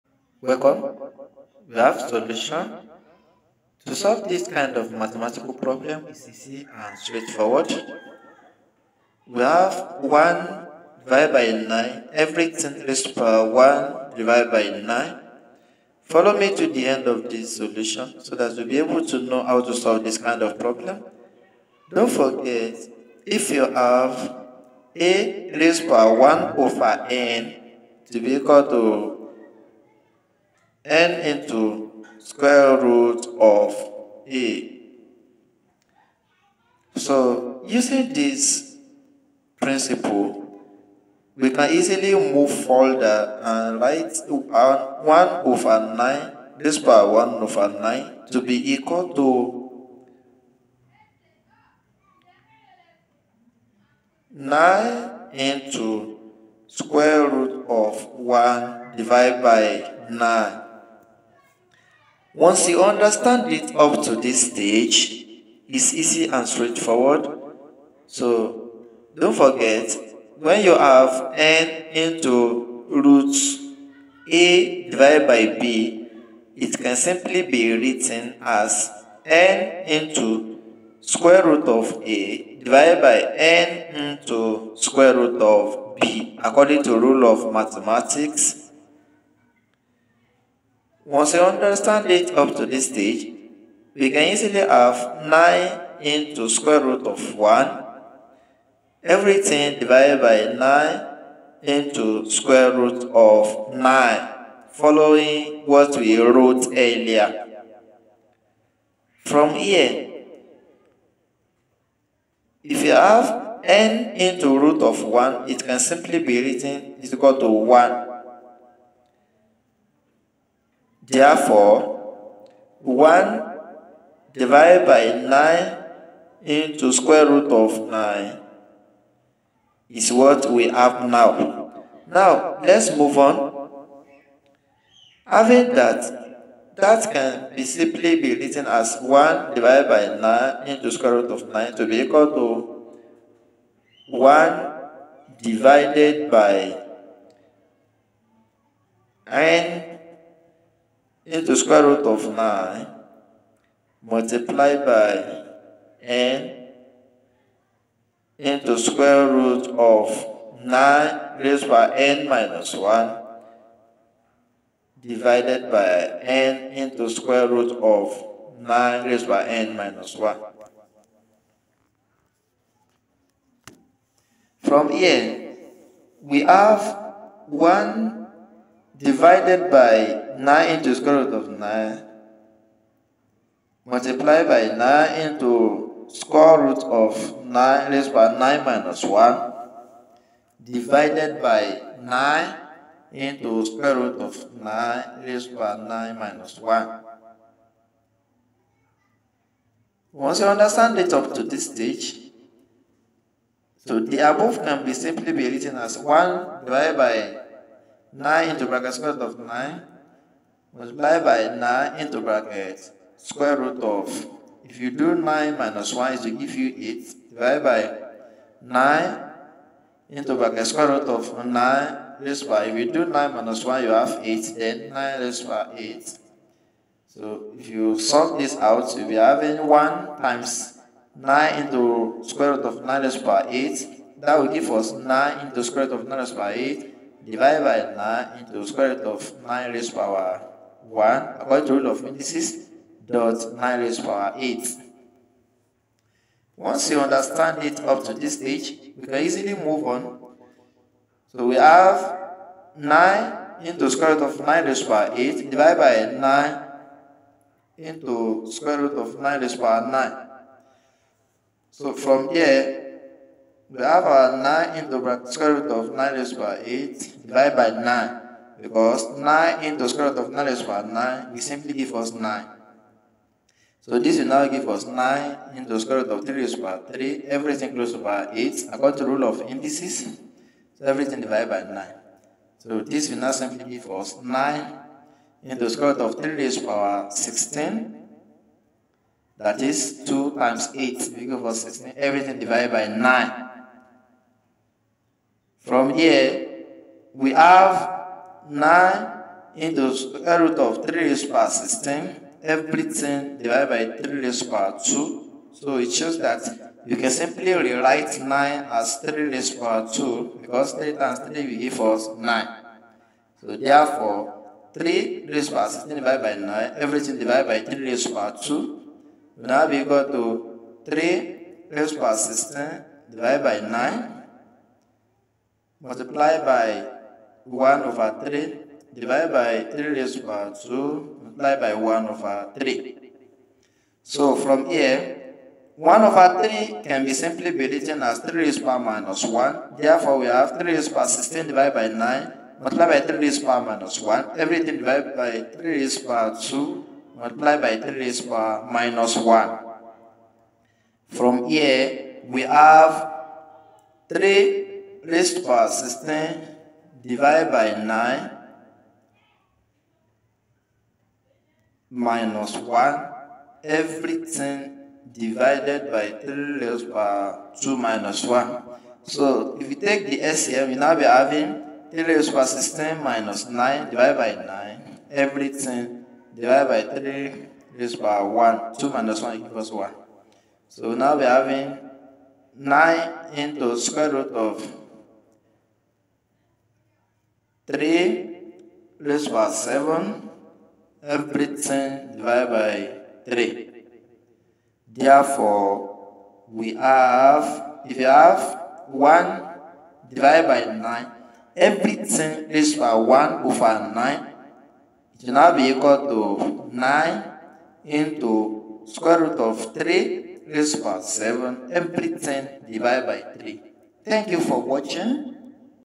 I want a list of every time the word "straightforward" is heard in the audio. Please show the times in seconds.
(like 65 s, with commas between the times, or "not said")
6 s, 66 s.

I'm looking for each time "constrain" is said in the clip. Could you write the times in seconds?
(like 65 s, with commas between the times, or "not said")
not said.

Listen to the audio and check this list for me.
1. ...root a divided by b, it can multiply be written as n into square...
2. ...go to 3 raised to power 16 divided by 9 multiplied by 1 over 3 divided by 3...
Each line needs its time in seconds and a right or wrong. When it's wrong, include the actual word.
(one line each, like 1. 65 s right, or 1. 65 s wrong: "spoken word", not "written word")
1. 72 s wrong: "simply", not "multiply"
2. 319 s right.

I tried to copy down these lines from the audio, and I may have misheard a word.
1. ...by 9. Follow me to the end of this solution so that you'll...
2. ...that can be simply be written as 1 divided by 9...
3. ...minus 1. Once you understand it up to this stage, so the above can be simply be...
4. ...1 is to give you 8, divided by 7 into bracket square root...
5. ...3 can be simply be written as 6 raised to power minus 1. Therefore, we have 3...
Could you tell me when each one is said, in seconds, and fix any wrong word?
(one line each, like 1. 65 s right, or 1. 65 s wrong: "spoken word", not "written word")
1. 14 s right
2. 136 s right
3. 196 s right
4. 215 s wrong: "9", not "7"
5. 336 s wrong: "3", not "6".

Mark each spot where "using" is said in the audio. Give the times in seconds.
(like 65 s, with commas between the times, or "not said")
37 s.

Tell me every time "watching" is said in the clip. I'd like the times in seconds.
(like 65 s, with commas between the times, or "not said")
414 s.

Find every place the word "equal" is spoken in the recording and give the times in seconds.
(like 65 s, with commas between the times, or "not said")
28 s, 48 s, 117 s, 142 s, 379 s, 405 s.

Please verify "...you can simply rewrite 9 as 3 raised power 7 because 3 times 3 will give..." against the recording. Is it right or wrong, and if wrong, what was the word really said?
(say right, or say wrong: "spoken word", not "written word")
wrong: "2", not "7".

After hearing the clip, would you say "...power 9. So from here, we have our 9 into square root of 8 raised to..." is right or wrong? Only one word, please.
wrong.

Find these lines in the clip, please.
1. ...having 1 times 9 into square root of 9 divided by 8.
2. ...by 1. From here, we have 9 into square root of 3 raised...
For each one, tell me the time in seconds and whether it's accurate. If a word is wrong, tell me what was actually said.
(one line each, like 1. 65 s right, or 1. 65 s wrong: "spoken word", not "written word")
1. 229 s wrong: "raised", not "divided"
2. 292 s wrong: "9", not "1".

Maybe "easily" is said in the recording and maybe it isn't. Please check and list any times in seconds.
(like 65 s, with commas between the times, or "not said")
41 s, 94 s, 249 s.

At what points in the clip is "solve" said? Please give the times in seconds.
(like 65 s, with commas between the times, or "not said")
3 s, 19 s.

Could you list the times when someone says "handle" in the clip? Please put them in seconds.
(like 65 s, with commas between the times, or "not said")
not said.